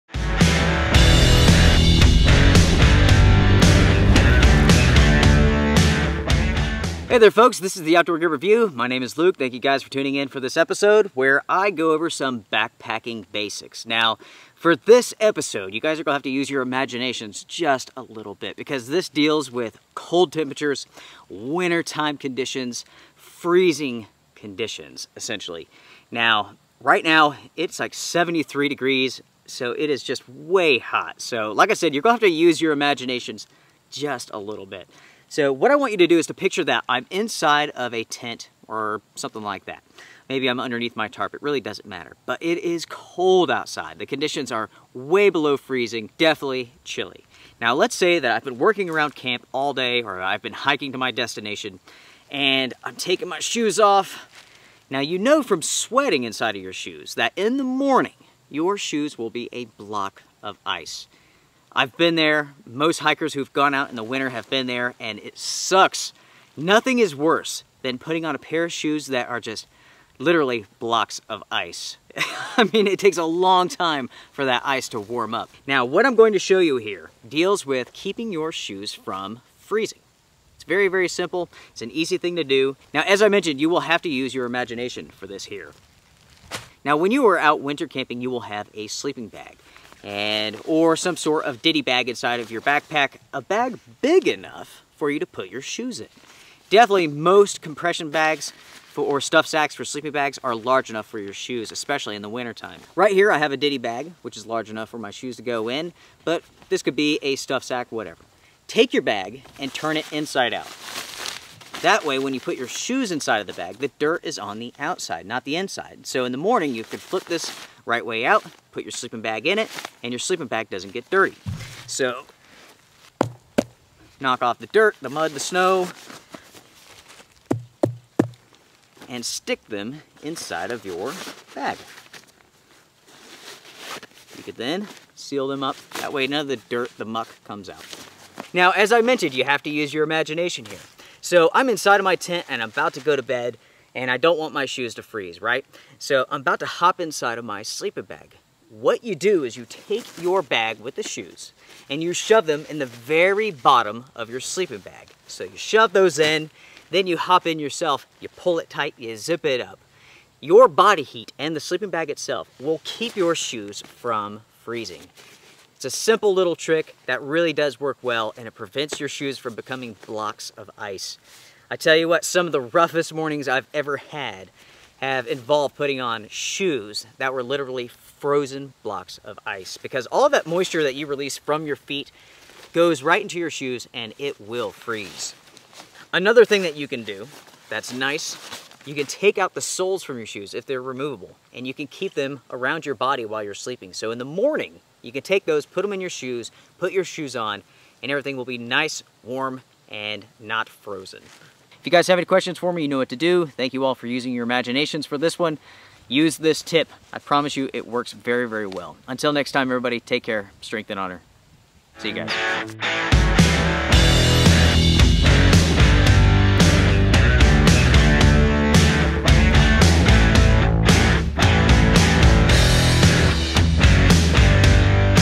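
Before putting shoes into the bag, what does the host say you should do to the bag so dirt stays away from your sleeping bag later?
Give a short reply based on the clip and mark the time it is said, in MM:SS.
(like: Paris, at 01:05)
Turn it inside out, at 01:49.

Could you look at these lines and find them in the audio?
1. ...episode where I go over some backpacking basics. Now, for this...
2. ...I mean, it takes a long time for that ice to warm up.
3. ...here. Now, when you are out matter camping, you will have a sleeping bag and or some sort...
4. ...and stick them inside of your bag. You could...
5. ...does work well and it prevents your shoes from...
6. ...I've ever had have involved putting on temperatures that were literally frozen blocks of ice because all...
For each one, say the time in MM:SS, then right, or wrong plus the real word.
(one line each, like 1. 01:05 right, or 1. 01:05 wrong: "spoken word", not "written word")
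1. 00:10 right
2. 01:12 right
3. 01:25 wrong: "winter", not "matter"
4. 02:09 right
5. 02:47 right
6. 02:53 wrong: "shoes", not "temperatures".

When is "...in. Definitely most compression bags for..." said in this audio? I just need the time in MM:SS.
01:35.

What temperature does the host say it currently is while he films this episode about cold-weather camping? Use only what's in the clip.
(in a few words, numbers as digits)
73 degrees.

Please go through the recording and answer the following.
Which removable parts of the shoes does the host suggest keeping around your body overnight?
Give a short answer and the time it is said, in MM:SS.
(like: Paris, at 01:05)
the soles, at 03:09.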